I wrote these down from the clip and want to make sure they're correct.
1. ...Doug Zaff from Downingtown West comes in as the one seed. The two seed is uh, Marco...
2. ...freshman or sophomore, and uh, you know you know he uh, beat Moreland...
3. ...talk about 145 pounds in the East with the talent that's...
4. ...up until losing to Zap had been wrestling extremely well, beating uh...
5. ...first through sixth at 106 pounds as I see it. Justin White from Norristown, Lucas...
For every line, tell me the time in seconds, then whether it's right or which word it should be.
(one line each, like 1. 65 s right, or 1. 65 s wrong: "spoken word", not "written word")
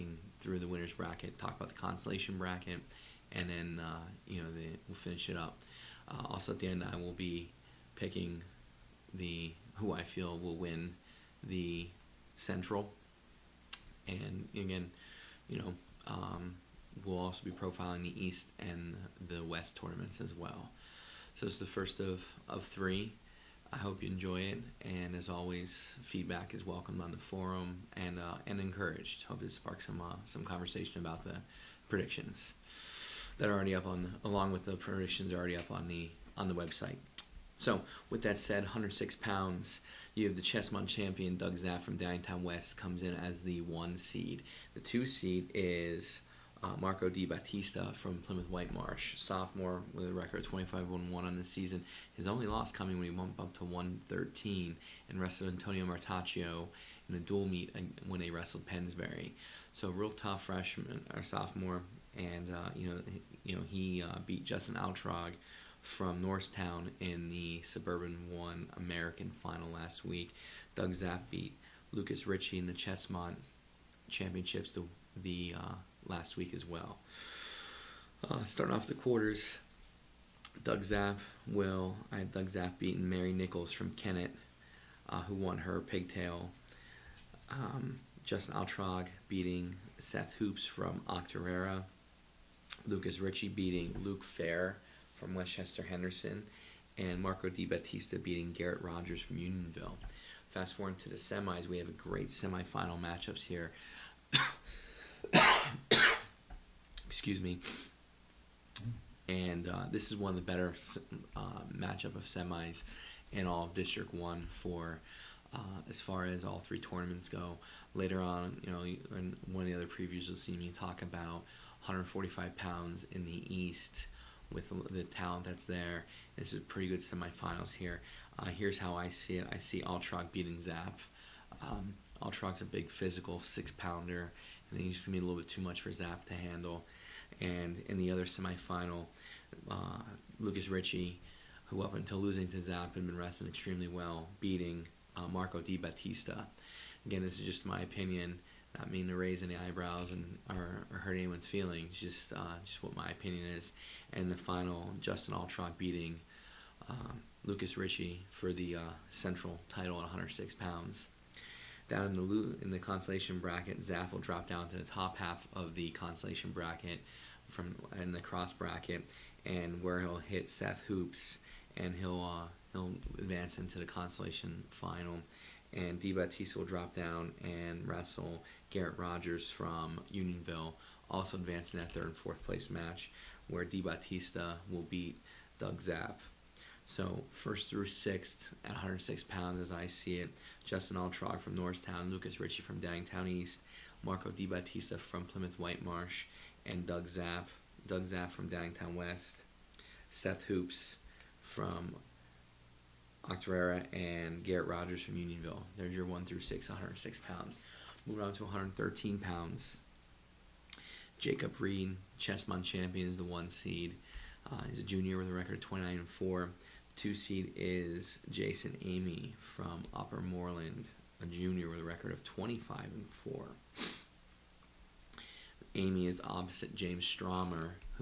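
1. 41 s right
2. 60 s wrong: "Justin", not "Moreland"
3. 120 s right
4. 141 s right
5. 187 s wrong: "Altrog", not "White".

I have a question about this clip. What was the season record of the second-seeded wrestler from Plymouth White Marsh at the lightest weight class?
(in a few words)
25-1-1.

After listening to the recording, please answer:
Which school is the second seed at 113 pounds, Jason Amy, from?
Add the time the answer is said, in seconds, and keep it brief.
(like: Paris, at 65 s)
Upper Moreland, at 219 s.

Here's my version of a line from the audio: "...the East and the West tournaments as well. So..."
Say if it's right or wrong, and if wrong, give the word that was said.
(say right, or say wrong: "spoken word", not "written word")
right.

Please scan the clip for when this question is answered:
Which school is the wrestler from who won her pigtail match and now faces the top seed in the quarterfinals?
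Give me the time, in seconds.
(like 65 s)
83 s.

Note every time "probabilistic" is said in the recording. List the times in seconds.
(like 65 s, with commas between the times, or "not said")
not said.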